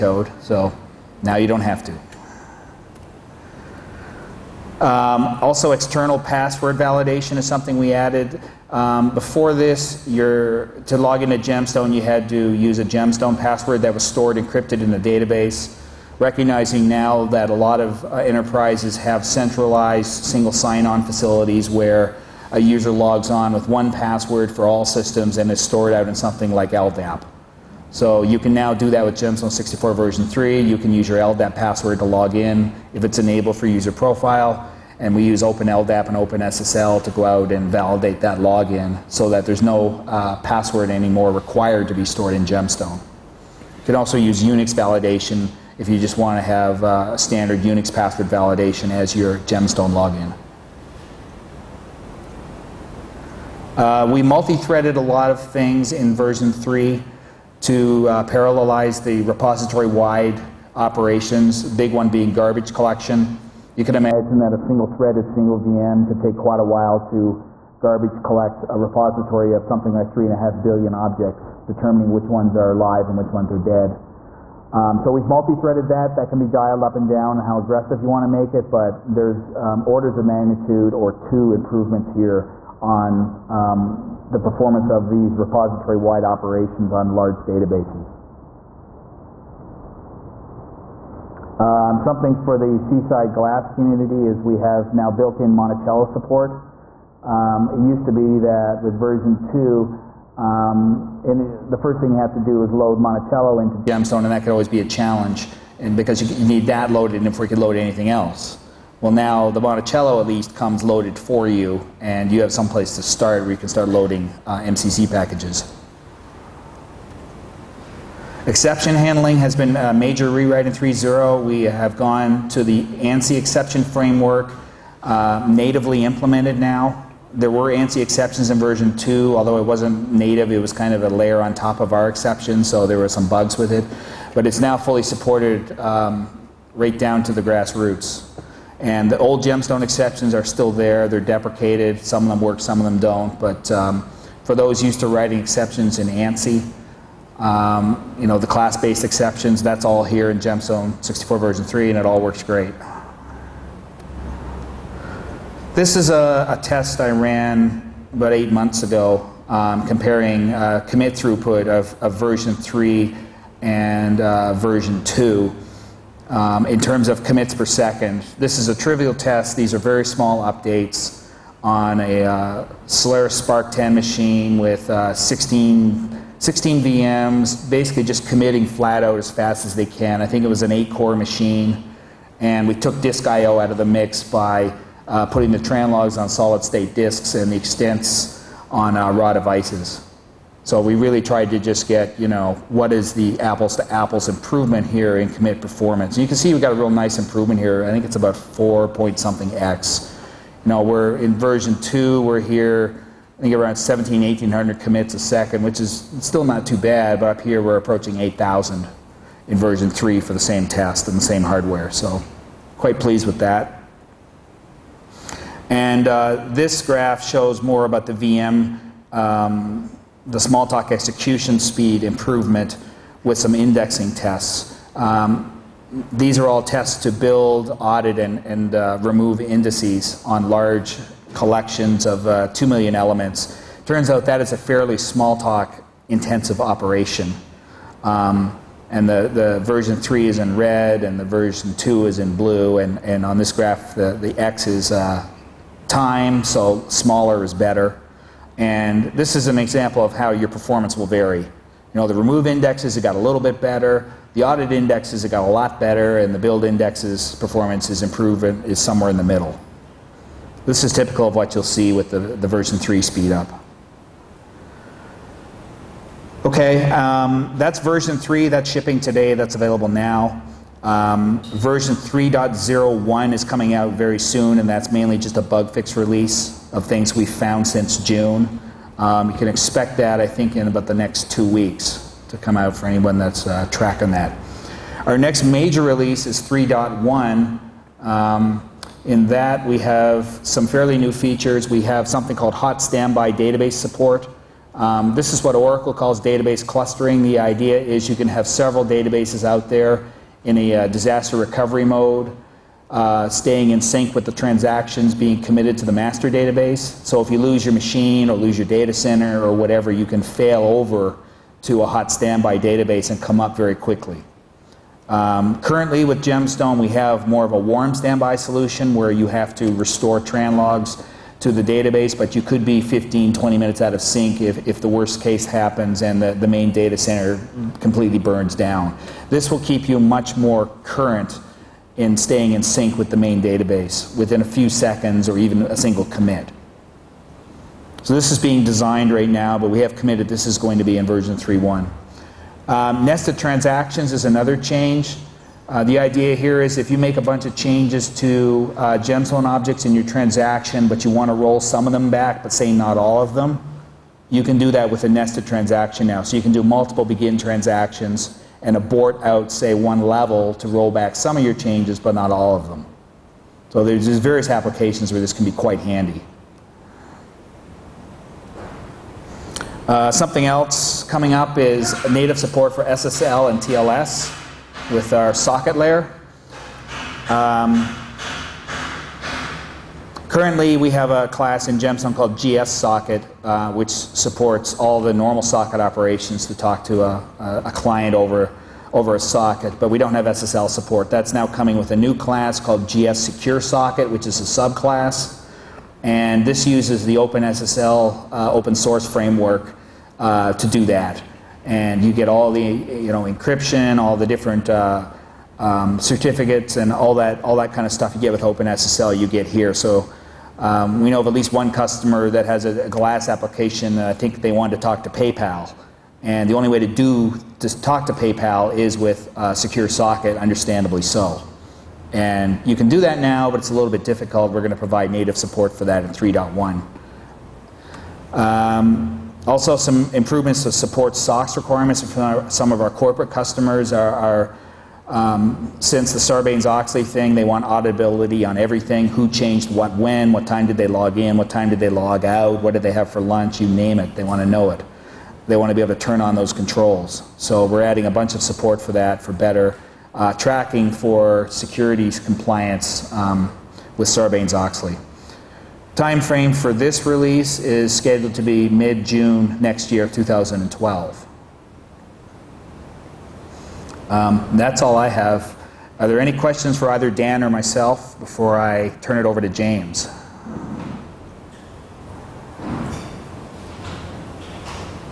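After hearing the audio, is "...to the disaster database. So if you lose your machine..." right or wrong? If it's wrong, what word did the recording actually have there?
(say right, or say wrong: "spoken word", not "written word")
wrong: "master", not "disaster".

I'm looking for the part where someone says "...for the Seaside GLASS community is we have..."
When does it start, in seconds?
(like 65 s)
92 s.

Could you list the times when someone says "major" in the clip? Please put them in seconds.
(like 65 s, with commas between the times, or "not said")
119 s, 285 s.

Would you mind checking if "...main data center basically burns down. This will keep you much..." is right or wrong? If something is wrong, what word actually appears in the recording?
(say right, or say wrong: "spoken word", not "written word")
wrong: "completely", not "basically".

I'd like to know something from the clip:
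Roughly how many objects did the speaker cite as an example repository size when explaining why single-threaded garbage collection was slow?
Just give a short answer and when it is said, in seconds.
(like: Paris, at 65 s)
3.5 billion, at 70 s.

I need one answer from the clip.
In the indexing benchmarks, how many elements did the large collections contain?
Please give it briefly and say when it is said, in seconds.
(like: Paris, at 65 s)
2 million, at 232 s.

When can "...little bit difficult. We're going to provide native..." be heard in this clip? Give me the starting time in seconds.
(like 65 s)
423 s.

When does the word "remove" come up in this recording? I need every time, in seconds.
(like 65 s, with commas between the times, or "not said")
229 s, 252 s.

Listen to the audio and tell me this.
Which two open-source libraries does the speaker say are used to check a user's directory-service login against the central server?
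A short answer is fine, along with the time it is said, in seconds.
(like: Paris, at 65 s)
OpenLDAP and OpenSSL, at 35 s.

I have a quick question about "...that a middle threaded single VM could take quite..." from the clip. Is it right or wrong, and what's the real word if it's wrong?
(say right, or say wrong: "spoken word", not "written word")
wrong: "single", not "middle".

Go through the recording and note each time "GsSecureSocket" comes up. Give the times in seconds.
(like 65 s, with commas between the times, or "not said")
392 s.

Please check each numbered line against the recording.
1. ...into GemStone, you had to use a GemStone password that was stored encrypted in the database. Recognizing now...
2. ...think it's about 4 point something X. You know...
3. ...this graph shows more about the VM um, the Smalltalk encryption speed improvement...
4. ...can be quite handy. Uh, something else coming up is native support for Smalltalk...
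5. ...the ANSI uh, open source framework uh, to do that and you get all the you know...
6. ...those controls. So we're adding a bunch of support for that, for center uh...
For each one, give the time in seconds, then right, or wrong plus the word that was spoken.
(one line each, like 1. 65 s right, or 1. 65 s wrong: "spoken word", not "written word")
1. 11 s right
2. 197 s right
3. 216 s wrong: "execution", not "encryption"
4. 365 s wrong: "SSL", not "Smalltalk"
5. 397 s wrong: "OpenSSL", not "ANSI"
6. 446 s wrong: "better", not "center".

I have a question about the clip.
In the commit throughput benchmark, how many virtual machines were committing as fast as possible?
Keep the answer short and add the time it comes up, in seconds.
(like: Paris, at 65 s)
16, at 176 s.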